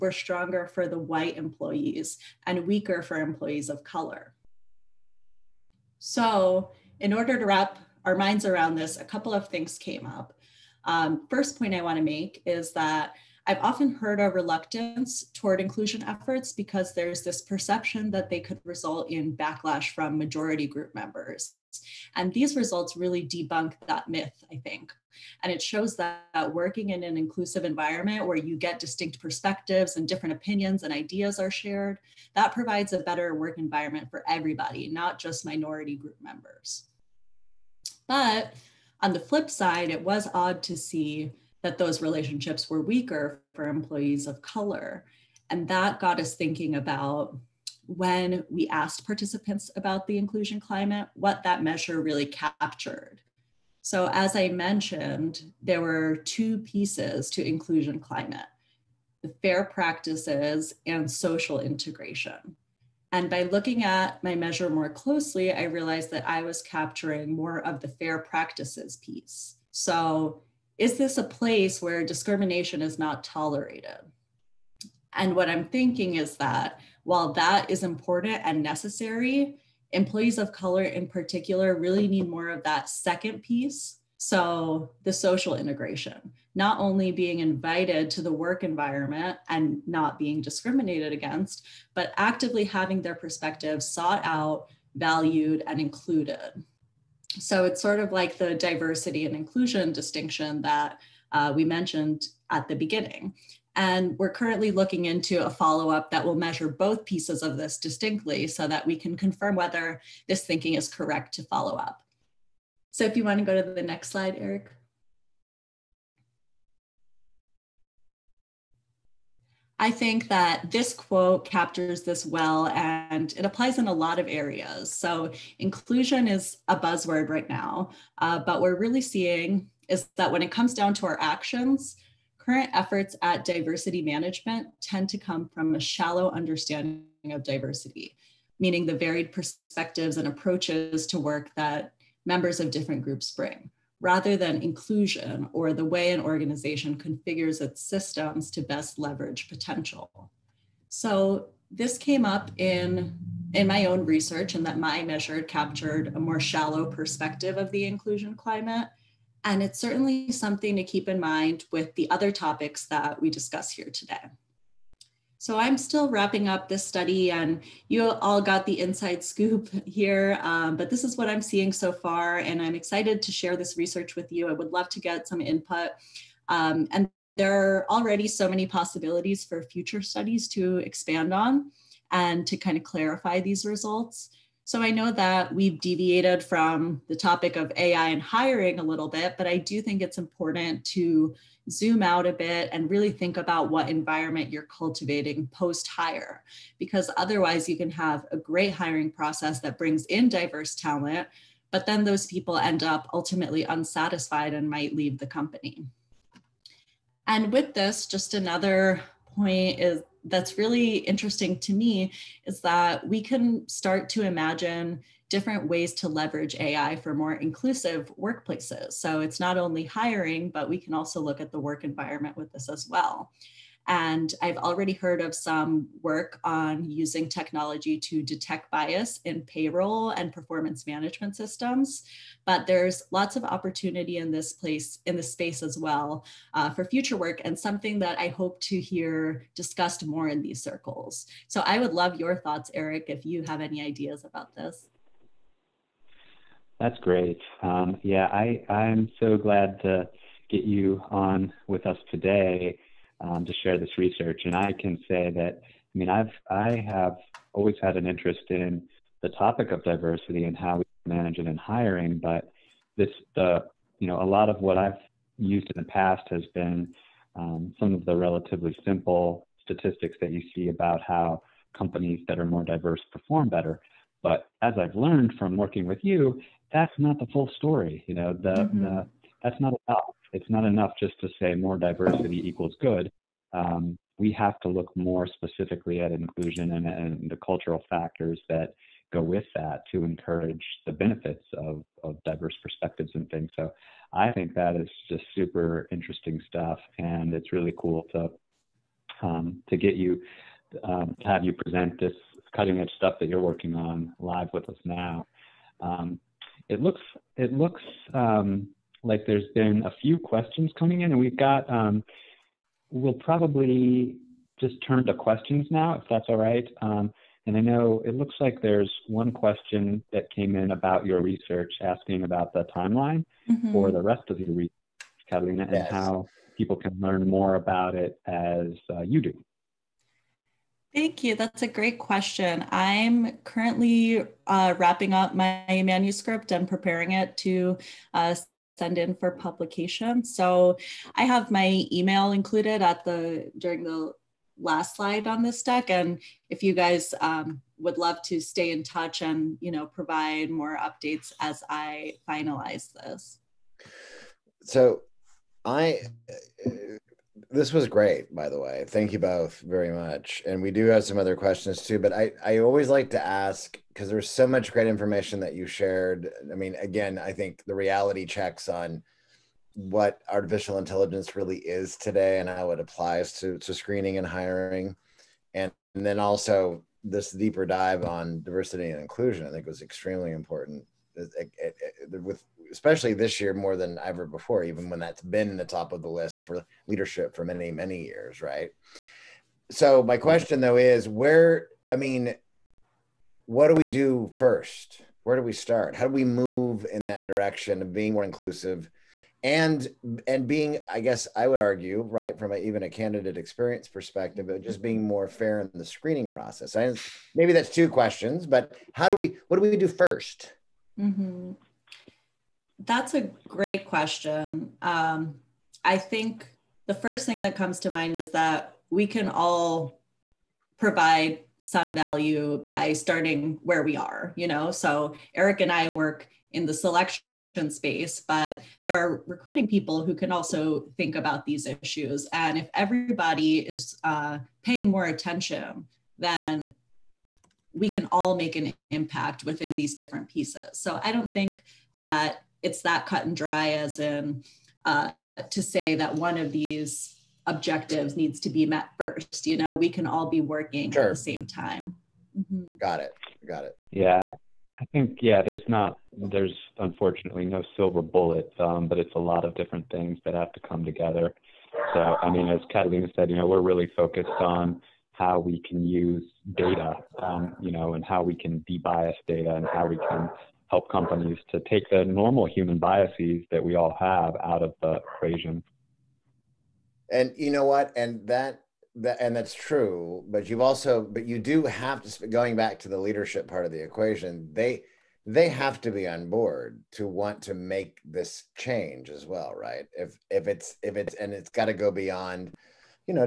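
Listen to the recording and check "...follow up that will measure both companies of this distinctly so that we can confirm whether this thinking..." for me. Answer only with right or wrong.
wrong.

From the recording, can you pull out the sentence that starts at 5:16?
Um, and I know it looks like there's one question that came in about your research asking about the timeline mm -hmm.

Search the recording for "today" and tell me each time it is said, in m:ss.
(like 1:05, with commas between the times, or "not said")
2:43, 4:12, 6:11.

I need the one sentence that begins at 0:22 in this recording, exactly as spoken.
And these results really debunk that myth, I think.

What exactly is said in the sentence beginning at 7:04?
So Eric and I work in the selection space, but there are recruiting people who can also think about these issues.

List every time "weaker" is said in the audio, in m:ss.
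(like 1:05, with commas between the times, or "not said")
0:02, 0:42.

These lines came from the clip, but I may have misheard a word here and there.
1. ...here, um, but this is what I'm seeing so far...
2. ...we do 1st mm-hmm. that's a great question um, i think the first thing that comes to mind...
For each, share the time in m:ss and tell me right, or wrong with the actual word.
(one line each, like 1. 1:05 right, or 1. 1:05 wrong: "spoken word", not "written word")
1. 2:49 right
2. 6:49 right.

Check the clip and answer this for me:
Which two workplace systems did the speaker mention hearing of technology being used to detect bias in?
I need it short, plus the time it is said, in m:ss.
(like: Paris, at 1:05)
payroll and performance management, at 3:49.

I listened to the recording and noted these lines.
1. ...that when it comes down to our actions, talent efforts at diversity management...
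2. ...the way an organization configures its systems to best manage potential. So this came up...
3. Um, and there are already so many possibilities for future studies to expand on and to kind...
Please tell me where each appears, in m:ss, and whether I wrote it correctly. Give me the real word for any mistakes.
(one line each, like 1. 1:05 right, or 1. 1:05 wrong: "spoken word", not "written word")
1. 2:10 wrong: "current", not "talent"
2. 2:25 wrong: "leverage", not "manage"
3. 2:56 right.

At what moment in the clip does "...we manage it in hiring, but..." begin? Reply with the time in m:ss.
4:20.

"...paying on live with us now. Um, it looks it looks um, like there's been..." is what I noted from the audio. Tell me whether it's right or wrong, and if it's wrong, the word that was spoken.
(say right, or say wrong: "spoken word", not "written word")
wrong: "working", not "paying".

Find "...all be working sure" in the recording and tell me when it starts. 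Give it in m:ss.
7:30.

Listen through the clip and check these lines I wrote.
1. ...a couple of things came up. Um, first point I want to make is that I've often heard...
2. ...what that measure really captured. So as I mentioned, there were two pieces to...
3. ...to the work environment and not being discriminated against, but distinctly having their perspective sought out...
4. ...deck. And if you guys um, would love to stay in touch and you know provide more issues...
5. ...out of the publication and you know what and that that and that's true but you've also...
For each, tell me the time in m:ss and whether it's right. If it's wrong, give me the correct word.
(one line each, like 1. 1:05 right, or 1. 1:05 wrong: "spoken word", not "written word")
1. 0:08 right
2. 0:51 right
3. 1:28 wrong: "actively", not "distinctly"
4. 5:45 wrong: "updates", not "issues"
5. 7:54 wrong: "equation", not "publication".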